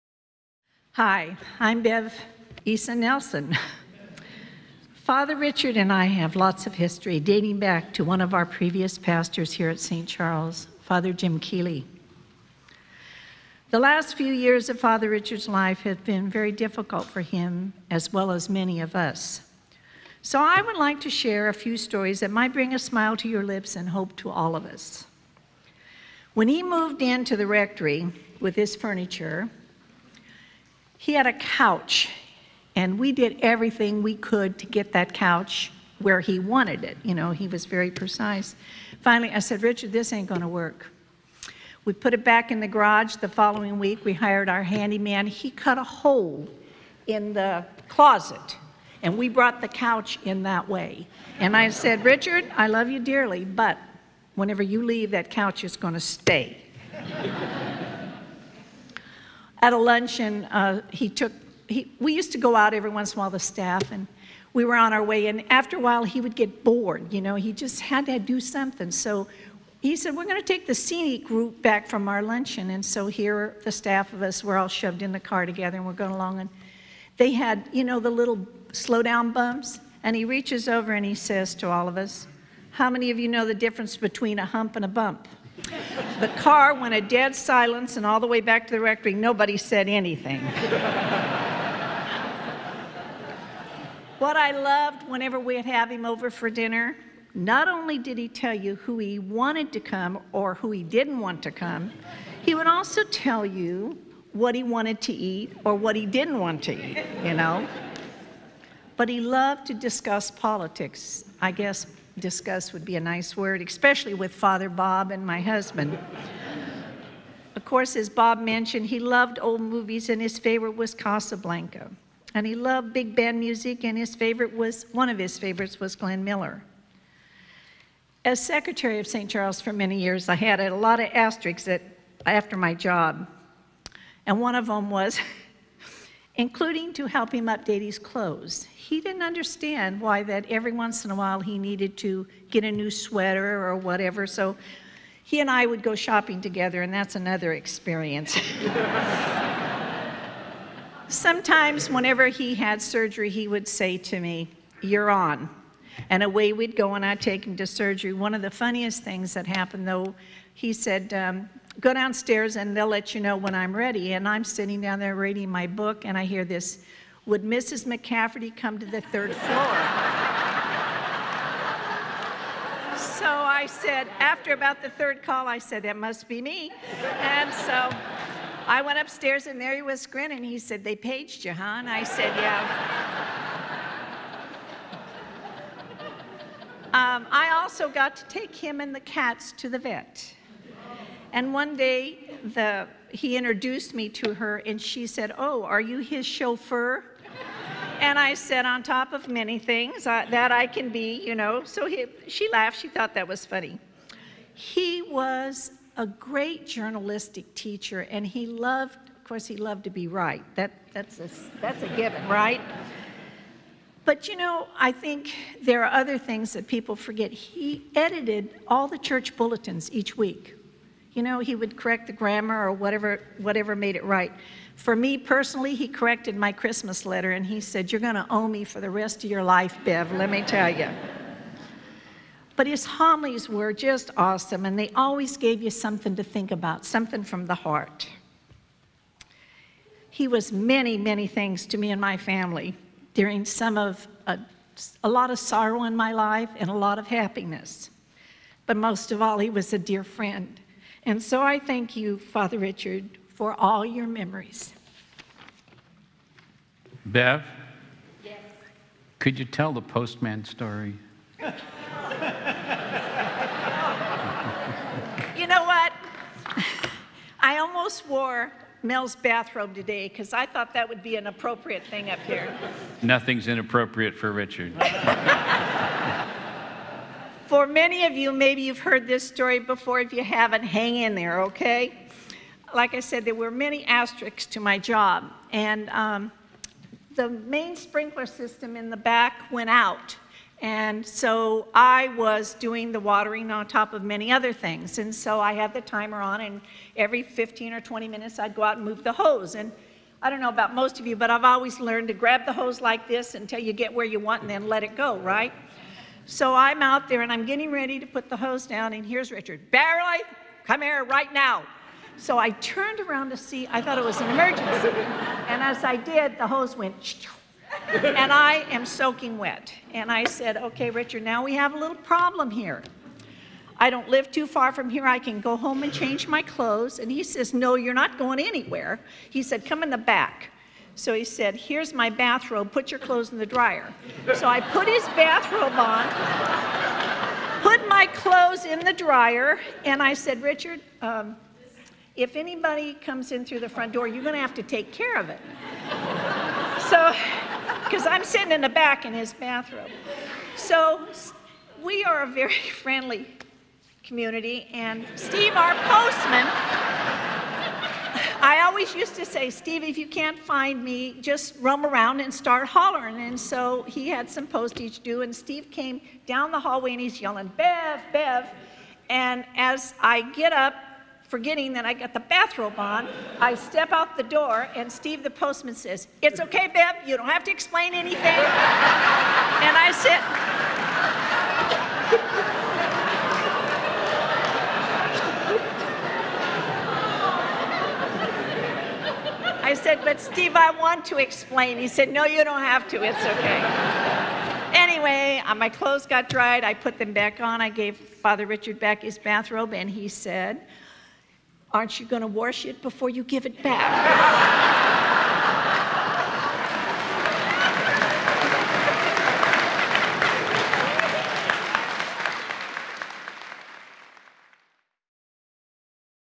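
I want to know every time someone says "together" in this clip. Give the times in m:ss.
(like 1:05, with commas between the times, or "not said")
1:15, 2:26.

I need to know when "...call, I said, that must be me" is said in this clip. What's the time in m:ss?
2:55.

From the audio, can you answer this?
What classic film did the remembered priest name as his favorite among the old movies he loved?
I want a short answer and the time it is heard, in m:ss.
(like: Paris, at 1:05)
Casablanca, at 2:00.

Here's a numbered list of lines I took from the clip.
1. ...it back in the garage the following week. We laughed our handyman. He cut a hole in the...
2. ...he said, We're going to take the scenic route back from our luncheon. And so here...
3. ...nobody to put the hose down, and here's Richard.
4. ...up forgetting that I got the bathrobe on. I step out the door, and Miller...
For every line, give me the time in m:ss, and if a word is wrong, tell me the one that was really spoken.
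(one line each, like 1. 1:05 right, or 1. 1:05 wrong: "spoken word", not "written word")
1. 0:42 wrong: "hired", not "laughed"
2. 1:09 right
3. 5:07 wrong: "ready", not "nobody"
4. 6:10 wrong: "Steve", not "Miller".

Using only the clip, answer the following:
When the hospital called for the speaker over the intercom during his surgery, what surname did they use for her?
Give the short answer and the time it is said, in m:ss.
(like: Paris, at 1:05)
McCafferty, at 2:47.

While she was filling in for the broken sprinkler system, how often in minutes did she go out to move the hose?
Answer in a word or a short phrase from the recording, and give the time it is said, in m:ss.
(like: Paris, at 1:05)
15 or 20, at 4:57.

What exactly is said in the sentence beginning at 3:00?
He said, they paged you, huh?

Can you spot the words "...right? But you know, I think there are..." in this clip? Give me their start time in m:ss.
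3:32.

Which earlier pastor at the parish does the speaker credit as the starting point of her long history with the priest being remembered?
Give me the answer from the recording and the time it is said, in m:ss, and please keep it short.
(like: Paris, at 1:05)
Father Jim Keeley, at 0:10.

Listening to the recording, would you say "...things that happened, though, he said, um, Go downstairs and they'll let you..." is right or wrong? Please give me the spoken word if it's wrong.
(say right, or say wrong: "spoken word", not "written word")
right.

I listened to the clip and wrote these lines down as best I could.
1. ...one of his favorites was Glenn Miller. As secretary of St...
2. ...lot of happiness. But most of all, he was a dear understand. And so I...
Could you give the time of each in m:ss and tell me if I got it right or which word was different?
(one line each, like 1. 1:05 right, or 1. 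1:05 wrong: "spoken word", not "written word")
1. 2:04 right
2. 4:06 wrong: "friend", not "understand".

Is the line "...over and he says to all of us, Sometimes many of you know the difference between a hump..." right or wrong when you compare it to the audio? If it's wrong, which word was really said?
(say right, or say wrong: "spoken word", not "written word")
wrong: "How", not "Sometimes".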